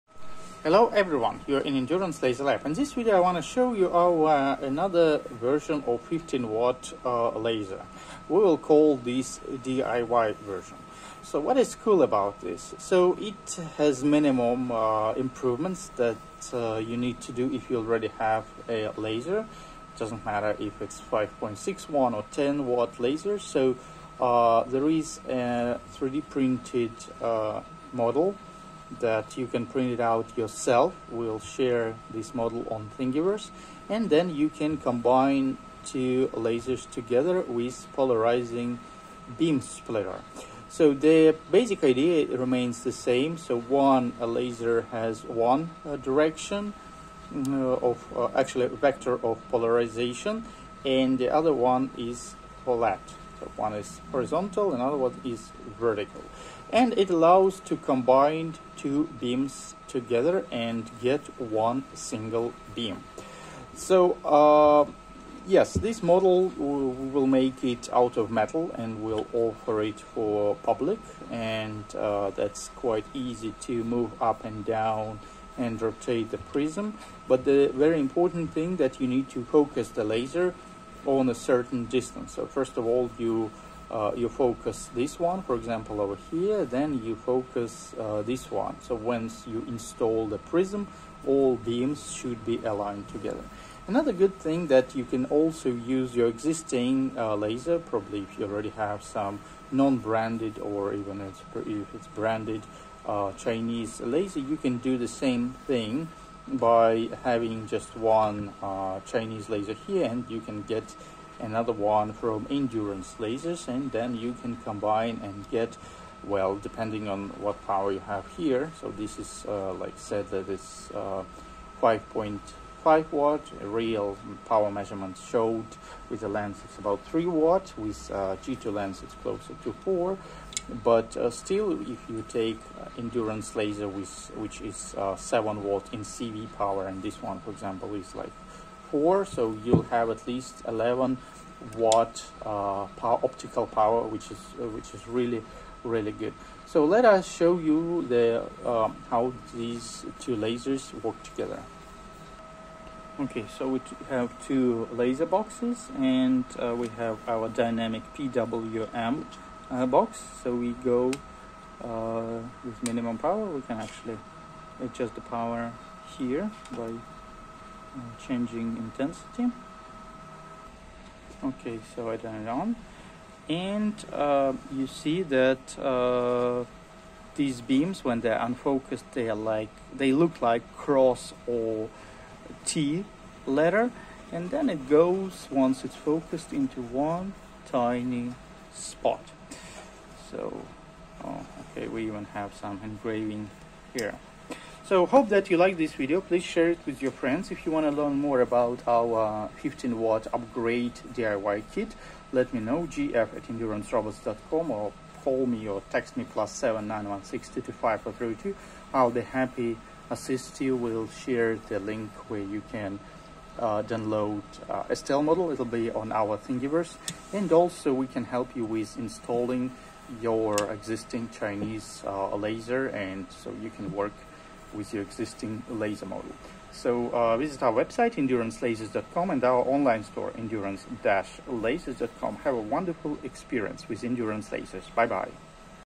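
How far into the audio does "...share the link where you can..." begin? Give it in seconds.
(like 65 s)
211 s.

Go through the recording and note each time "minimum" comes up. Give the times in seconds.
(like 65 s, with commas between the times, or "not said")
14 s, 162 s.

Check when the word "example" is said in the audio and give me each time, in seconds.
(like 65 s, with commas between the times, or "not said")
85 s, 137 s.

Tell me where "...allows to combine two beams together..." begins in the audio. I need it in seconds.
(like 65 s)
57 s.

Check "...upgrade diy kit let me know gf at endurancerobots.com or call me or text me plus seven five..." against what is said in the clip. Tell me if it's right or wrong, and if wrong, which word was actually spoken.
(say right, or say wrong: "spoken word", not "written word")
wrong: "nine", not "five".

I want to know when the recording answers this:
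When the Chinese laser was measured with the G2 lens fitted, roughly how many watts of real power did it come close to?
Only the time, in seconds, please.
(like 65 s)
129 s.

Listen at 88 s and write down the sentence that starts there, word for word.
So once you install the prism, all beams should be aligned together.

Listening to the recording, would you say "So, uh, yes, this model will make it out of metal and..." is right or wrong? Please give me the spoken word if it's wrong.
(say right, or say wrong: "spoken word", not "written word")
right.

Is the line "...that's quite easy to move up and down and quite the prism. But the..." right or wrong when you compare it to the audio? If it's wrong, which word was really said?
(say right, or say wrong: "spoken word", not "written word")
wrong: "rotate", not "quite".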